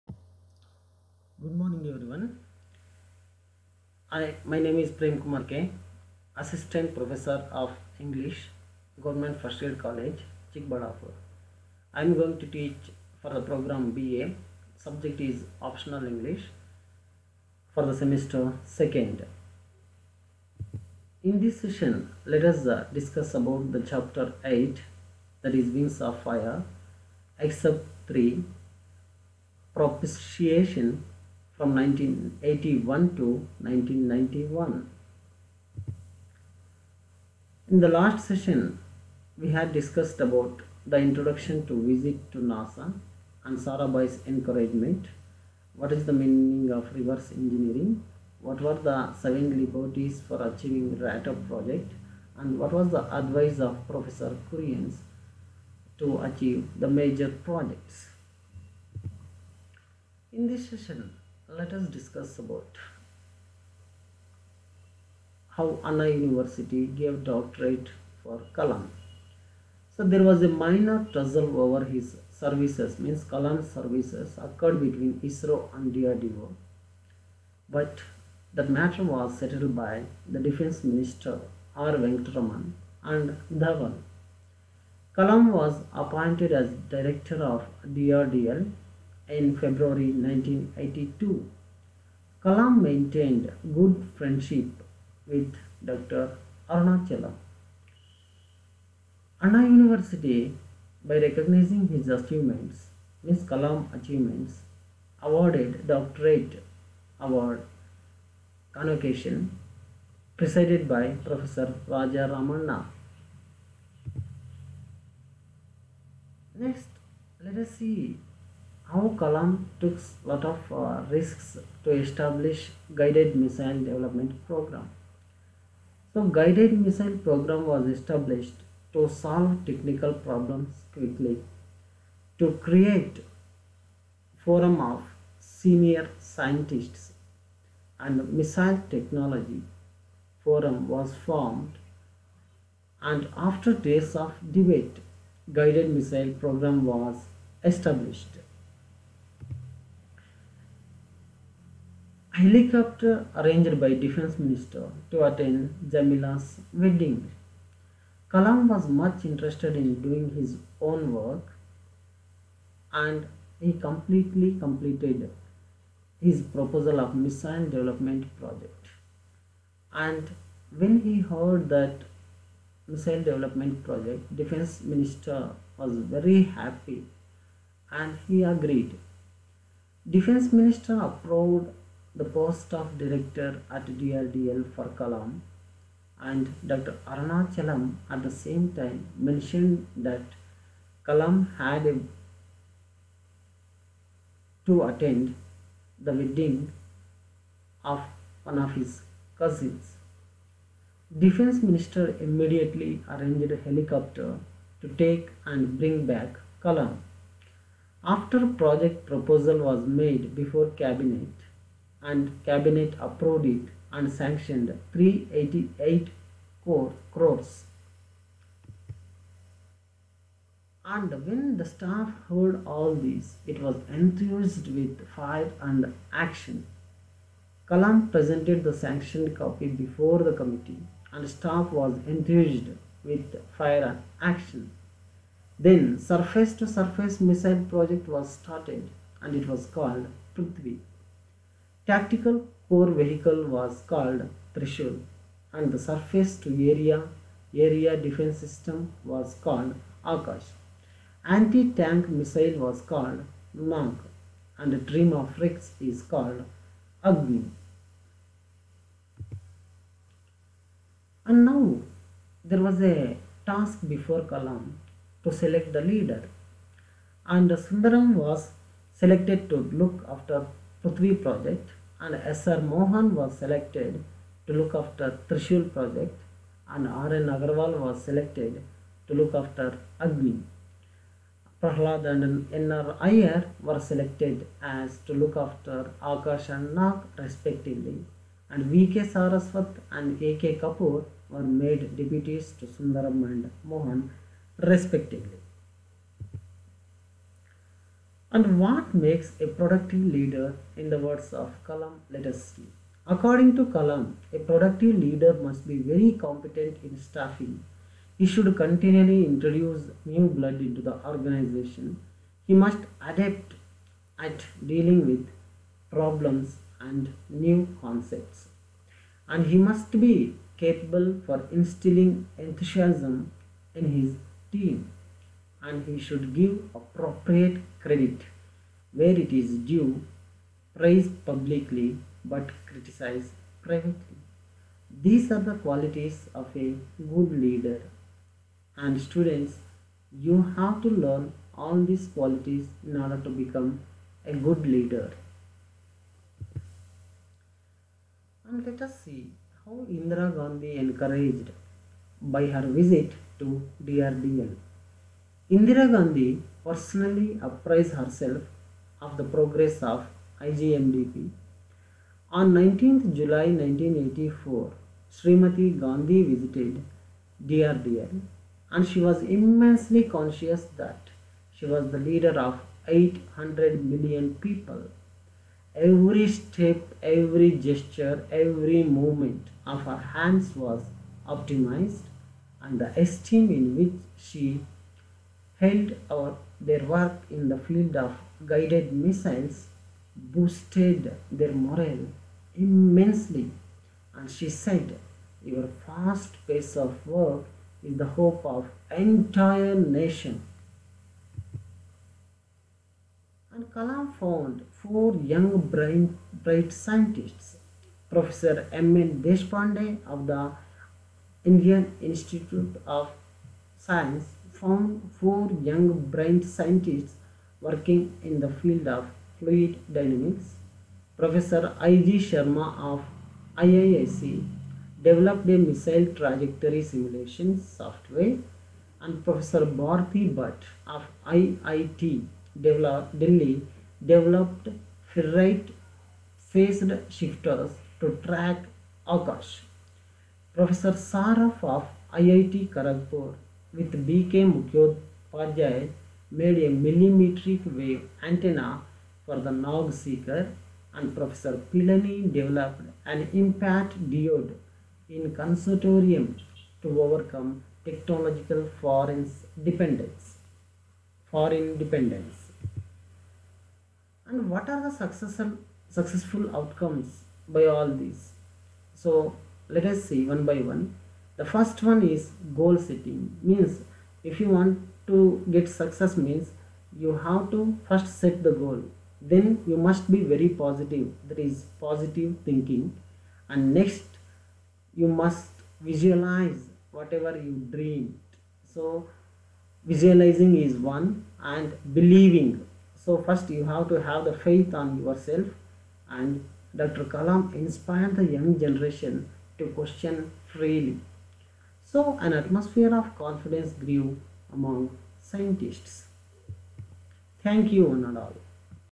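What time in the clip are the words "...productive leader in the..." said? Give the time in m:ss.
4:59.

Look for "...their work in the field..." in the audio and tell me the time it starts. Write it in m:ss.
6:26.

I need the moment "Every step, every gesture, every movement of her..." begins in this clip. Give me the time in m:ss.
6:15.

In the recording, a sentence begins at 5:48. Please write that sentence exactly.
And let us see how Indira Gandhi encouraged by her visit to DRDL.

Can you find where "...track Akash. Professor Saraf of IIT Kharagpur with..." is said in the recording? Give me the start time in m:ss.
7:18.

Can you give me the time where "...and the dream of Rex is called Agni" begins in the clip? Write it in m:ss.
4:14.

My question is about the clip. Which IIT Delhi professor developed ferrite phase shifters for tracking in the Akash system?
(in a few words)
Bharti Bhatt.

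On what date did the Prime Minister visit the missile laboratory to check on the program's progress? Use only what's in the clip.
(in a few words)
19 July 1984.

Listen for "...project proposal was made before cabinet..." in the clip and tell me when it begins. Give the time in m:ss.
3:28.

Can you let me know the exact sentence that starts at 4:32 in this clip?
Mohan was selected to look after Trishul project and R.N.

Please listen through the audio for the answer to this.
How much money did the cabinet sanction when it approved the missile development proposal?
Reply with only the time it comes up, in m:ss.
3:34.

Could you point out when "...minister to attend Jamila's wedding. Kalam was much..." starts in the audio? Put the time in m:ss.
2:34.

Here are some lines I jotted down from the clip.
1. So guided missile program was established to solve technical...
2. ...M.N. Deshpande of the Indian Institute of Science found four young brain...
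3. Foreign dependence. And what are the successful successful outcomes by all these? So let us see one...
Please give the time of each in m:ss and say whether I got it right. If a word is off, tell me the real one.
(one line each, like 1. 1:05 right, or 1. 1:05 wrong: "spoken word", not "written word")
1. 2:06 right
2. 6:48 right
3. 7:41 right.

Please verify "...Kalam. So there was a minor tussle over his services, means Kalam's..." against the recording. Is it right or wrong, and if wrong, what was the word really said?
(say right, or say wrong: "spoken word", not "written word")
right.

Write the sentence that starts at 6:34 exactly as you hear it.
And she said, Your fast pace of work is the hope of entire nation.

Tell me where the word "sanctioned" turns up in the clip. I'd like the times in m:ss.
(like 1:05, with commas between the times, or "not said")
3:34, 3:48.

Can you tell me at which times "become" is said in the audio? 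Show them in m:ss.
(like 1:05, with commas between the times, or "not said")
5:43.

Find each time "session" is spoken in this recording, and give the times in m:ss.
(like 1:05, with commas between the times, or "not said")
0:21, 0:38, 1:00.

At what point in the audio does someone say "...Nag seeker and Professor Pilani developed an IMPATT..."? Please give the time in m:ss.
7:29.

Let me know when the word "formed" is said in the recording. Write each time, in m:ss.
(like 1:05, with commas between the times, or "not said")
2:21.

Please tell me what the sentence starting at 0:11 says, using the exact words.
I am going to teach for the program BA.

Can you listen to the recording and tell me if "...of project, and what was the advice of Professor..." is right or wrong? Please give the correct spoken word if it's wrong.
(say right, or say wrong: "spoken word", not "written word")
right.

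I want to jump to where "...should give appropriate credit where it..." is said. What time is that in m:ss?
5:26.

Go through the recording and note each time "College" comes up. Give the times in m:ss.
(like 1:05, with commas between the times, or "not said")
0:09.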